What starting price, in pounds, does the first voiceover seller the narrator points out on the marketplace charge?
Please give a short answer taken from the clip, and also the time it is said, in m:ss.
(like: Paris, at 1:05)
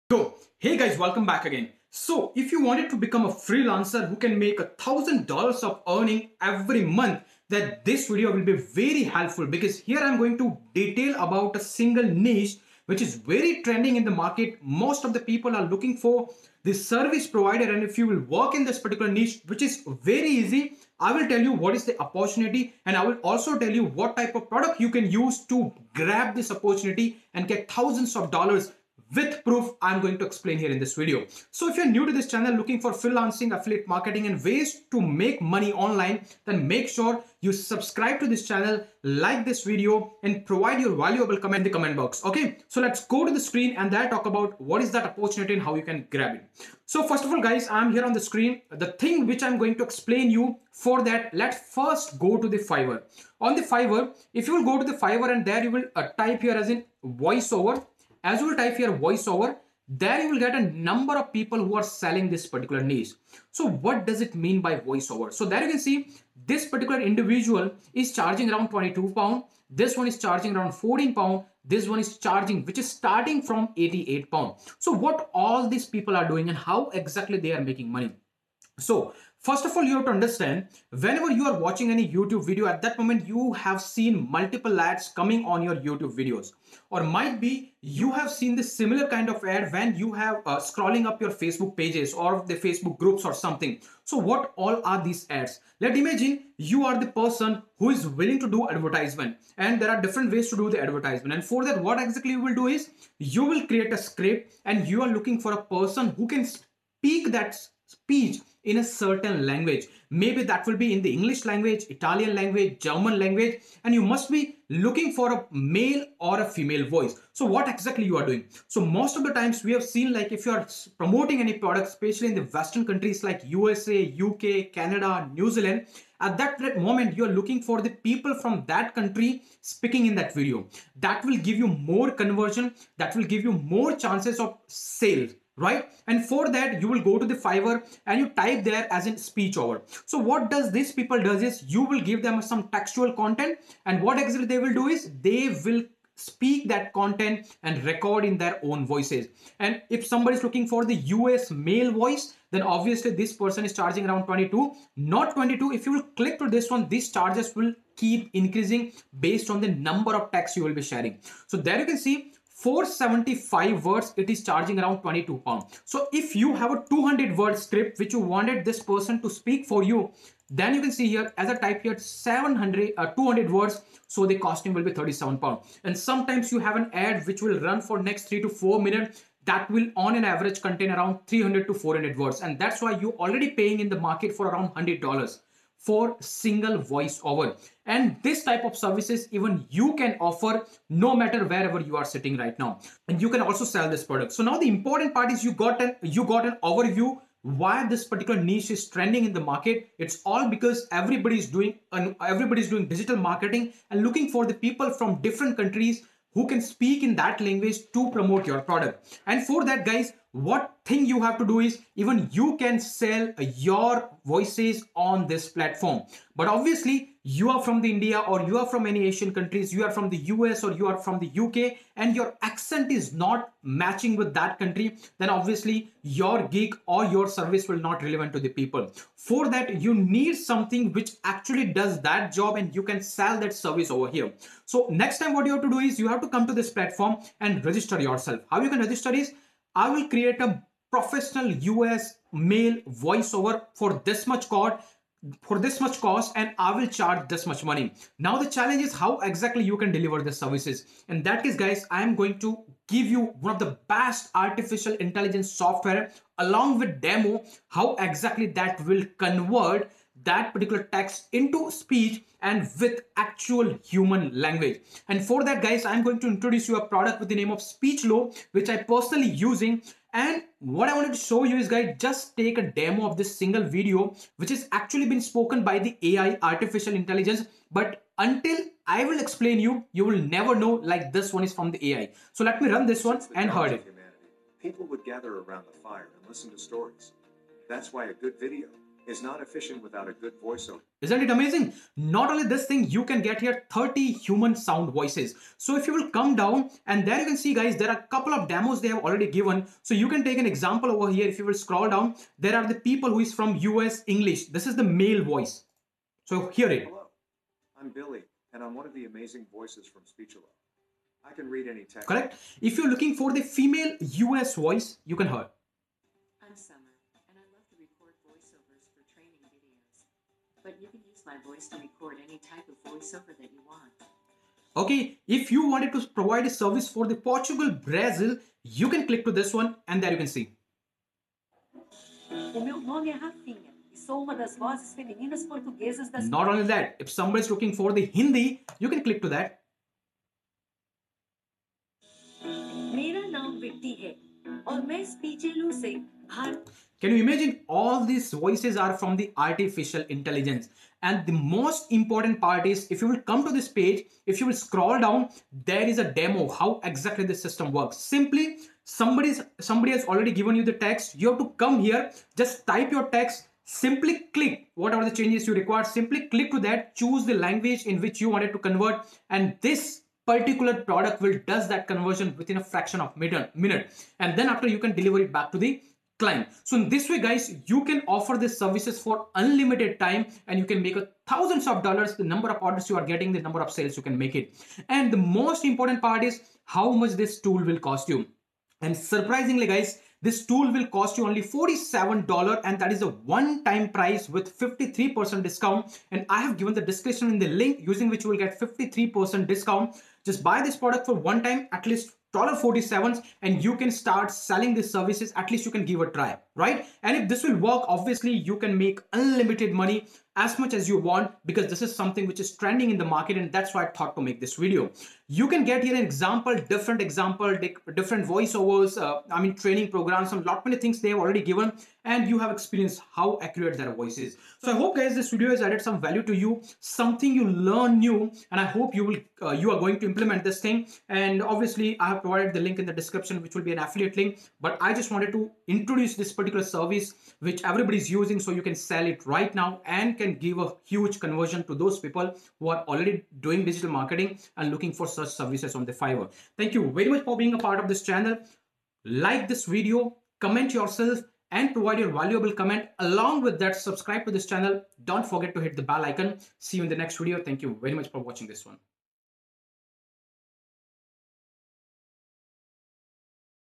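88 pound, at 1:13.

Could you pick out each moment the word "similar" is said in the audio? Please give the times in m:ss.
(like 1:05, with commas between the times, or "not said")
1:28.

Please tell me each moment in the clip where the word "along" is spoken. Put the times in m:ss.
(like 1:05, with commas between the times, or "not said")
4:16, 7:32.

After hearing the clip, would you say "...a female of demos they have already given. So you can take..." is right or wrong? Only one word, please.
wrong.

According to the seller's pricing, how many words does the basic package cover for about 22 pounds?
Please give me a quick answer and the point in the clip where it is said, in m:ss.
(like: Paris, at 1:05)
475, at 2:42.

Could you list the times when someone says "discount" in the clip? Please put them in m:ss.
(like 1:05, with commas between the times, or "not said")
6:35, 6:39.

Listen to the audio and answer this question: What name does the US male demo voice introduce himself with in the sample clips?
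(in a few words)
Billy.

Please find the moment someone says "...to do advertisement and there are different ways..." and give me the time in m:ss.
1:38.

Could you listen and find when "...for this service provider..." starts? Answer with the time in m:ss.
0:15.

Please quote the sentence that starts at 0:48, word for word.
The thing which I'm going to explain you for that, let's first go to the Fiverr.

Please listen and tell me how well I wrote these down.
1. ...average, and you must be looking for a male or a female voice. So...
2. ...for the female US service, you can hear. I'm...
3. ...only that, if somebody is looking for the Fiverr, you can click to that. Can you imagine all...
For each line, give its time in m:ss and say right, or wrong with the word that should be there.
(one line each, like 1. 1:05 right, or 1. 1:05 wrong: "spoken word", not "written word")
1. 1:53 wrong: "language", not "average"
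2. 5:13 wrong: "voice", not "service"
3. 5:36 wrong: "Hindi", not "Fiverr".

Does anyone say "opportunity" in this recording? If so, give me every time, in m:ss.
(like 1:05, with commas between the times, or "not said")
0:21, 0:26, 0:45.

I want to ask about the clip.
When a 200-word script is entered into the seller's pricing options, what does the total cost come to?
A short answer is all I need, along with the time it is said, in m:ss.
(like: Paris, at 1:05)
37 pound, at 2:54.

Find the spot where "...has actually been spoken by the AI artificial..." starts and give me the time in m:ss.
4:34.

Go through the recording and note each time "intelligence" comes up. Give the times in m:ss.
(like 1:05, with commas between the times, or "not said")
4:14, 4:36, 5:50.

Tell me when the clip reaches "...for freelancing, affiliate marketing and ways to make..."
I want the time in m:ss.
0:32.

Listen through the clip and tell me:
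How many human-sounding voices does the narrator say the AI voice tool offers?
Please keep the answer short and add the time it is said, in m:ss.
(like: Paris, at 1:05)
30, at 4:53.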